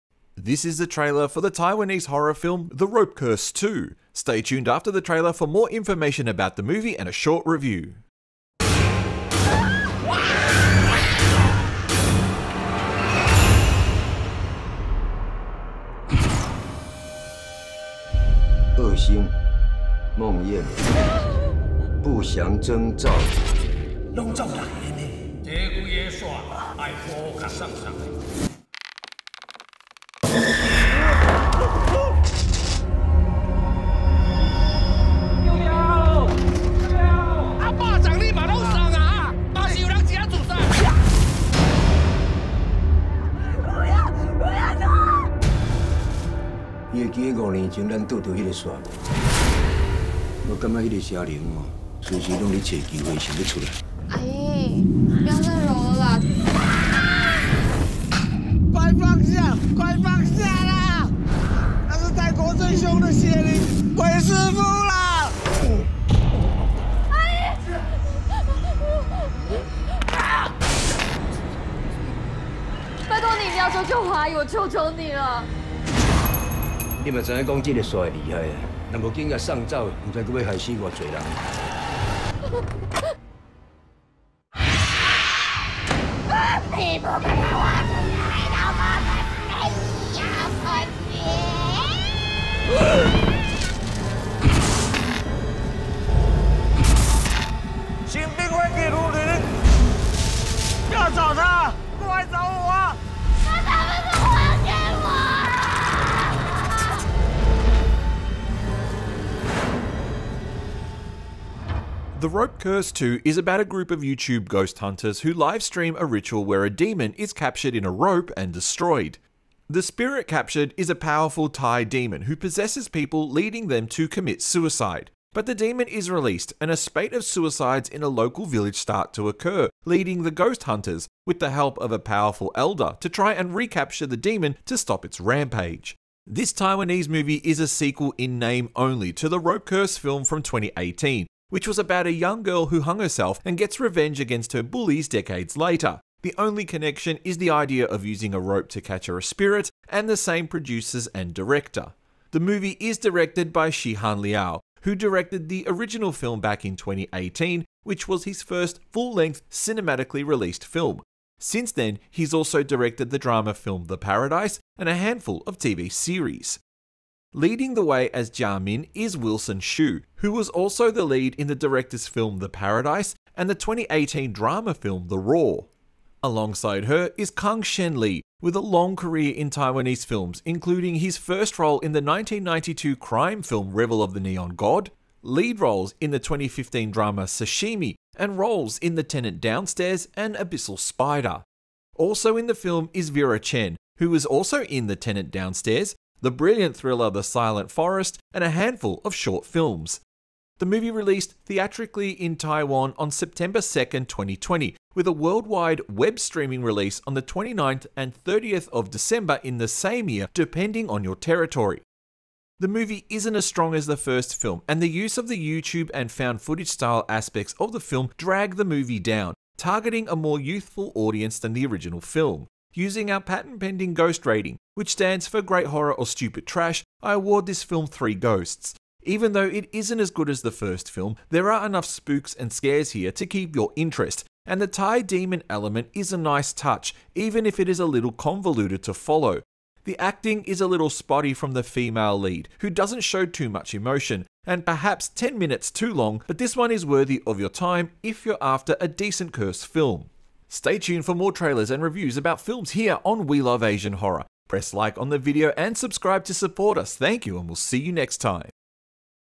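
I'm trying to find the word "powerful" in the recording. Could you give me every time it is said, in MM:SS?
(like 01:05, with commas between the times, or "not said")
02:00, 02:11.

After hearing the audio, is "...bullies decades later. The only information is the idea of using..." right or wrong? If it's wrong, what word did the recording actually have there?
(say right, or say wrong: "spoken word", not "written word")
wrong: "connection", not "information".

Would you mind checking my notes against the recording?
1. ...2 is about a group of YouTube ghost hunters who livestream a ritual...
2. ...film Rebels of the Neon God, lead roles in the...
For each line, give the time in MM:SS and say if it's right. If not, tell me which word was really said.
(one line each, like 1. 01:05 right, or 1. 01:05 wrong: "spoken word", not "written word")
1. 01:52 right
2. 03:03 right.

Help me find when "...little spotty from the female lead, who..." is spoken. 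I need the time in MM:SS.
04:00.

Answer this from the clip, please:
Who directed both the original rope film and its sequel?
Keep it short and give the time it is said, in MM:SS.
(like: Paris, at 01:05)
Shih-han Liao, at 02:33.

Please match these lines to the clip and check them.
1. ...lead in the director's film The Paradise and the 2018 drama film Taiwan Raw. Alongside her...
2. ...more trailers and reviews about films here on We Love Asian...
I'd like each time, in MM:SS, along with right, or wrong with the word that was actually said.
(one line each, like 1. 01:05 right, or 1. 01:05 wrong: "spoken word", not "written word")
1. 02:51 wrong: "The", not "Taiwan"
2. 04:11 right.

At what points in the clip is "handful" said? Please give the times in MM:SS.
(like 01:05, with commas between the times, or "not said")
02:44, 03:18.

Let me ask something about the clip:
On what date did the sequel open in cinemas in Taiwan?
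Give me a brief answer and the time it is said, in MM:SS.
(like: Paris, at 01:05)
September 2, 2020, at 03:23.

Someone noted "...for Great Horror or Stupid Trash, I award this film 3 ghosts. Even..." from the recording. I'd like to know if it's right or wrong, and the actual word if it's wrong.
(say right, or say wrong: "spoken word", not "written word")
right.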